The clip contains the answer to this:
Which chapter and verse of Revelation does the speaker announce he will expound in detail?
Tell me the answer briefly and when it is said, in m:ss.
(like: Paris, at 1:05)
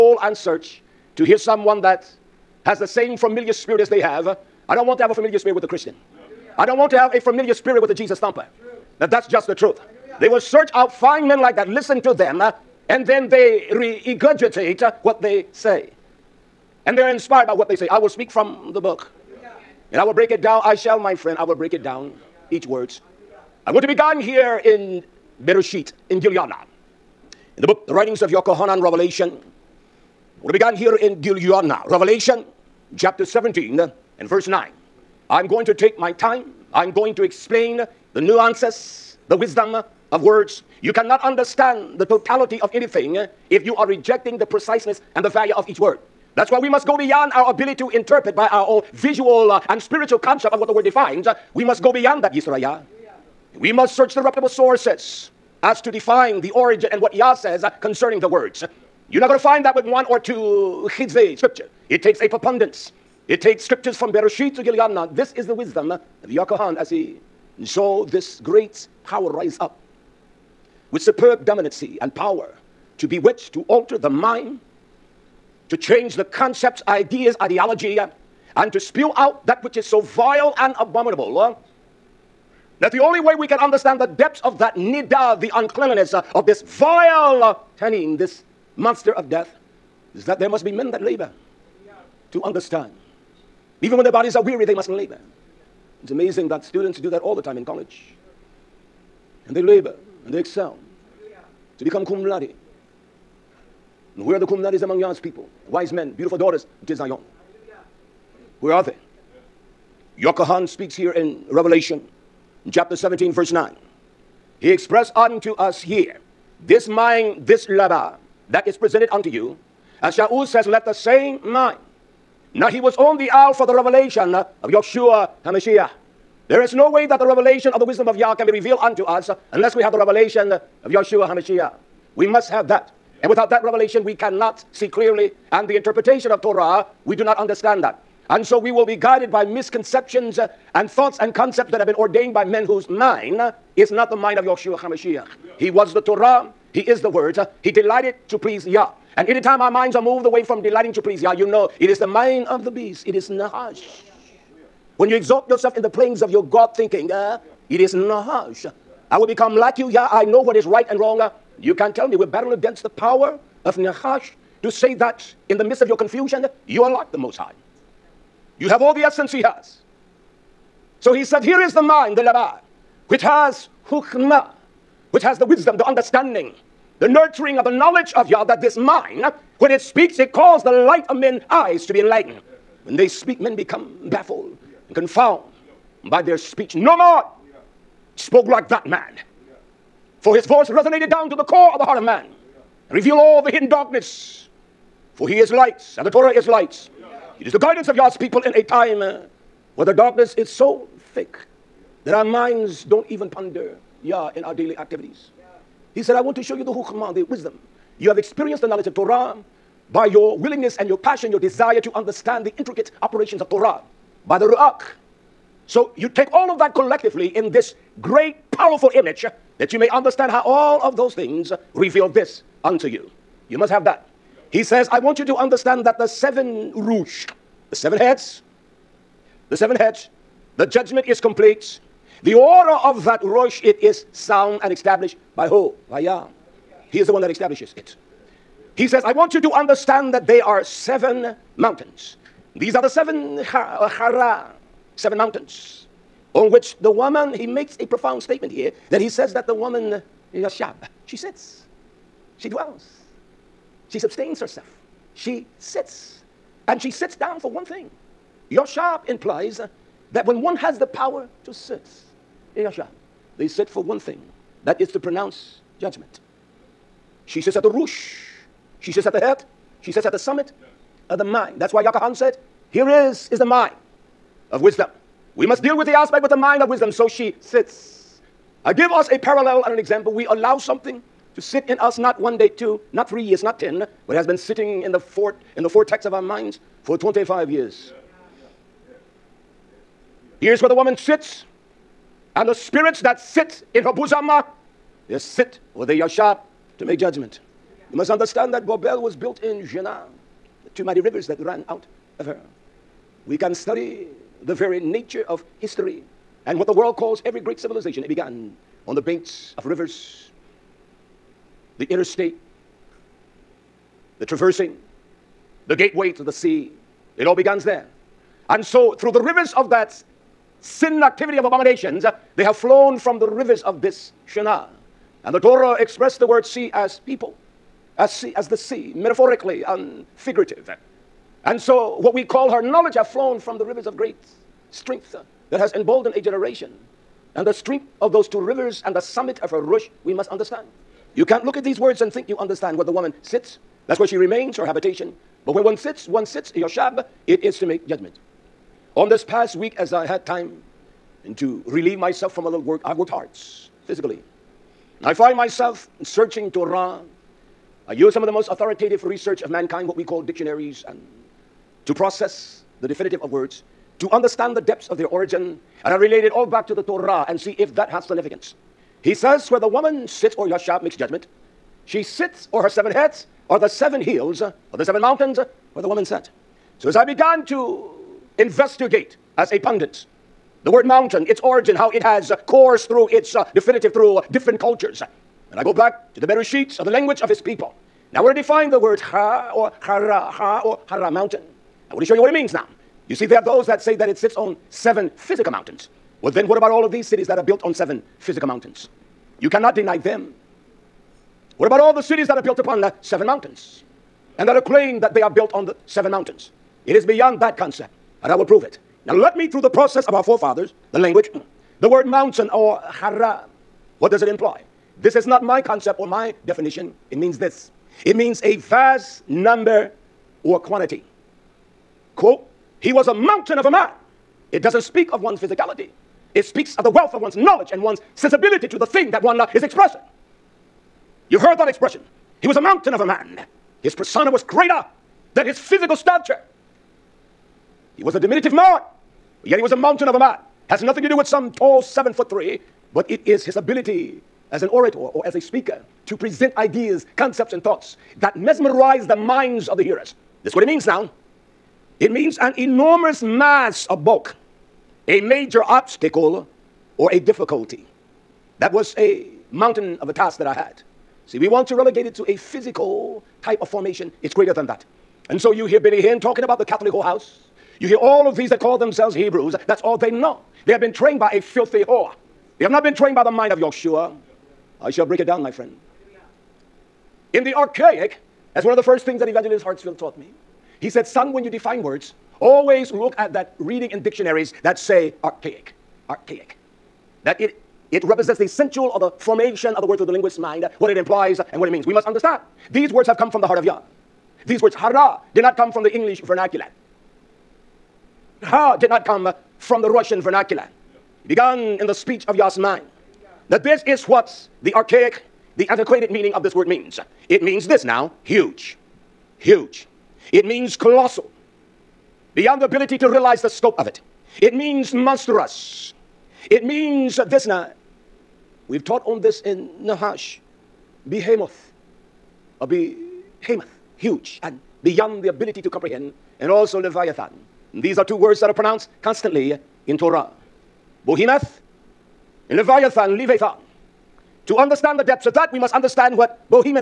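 Chapter 17, verse 9, at 0:31.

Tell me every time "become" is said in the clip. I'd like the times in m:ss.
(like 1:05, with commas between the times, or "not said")
1:41, 2:39, 3:03.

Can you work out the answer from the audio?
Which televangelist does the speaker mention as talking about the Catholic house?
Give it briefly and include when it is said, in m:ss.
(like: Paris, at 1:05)
Benny Hinn, at 7:45.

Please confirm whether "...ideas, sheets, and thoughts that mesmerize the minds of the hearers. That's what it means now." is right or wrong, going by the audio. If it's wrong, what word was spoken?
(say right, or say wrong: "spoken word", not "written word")
wrong: "concepts", not "sheets".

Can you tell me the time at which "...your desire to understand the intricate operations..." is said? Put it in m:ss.
3:31.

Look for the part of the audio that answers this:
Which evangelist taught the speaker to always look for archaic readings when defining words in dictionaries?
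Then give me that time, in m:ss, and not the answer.
7:59.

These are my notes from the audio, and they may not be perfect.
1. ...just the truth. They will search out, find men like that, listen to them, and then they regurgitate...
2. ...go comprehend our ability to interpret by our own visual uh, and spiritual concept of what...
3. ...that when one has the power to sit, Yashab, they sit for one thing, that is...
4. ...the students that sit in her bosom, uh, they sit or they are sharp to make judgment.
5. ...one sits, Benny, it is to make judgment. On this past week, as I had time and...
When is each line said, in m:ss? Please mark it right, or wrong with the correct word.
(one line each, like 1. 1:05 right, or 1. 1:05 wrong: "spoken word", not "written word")
1. 0:09 right
2. 0:46 wrong: "beyond", not "comprehend"
3. 4:20 right
4. 4:52 wrong: "spirits", not "students"
5. 5:46 wrong: "Yoshab", not "Benny".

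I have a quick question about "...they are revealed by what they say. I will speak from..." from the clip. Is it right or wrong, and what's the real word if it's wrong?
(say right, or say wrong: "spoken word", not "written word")
wrong: "inspired", not "revealed".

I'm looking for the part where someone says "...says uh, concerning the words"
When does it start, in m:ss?
0:57.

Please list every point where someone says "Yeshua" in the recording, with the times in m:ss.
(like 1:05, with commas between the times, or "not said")
2:04, 2:10, 2:24, 7:53.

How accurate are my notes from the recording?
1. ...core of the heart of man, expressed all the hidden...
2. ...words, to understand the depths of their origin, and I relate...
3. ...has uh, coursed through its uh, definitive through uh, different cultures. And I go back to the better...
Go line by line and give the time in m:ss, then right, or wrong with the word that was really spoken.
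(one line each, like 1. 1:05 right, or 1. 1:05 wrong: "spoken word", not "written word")
1. 3:11 wrong: "revealed", not "expressed"
2. 6:03 right
3. 6:22 right.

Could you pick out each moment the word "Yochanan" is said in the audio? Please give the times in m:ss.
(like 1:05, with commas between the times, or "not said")
0:28, 1:50.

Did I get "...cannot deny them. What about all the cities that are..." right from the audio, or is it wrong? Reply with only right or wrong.
right.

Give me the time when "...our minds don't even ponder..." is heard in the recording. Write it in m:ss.
3:22.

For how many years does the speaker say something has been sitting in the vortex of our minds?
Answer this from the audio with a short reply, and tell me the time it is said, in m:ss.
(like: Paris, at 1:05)
25, at 4:46.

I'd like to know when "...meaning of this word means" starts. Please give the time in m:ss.
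8:26.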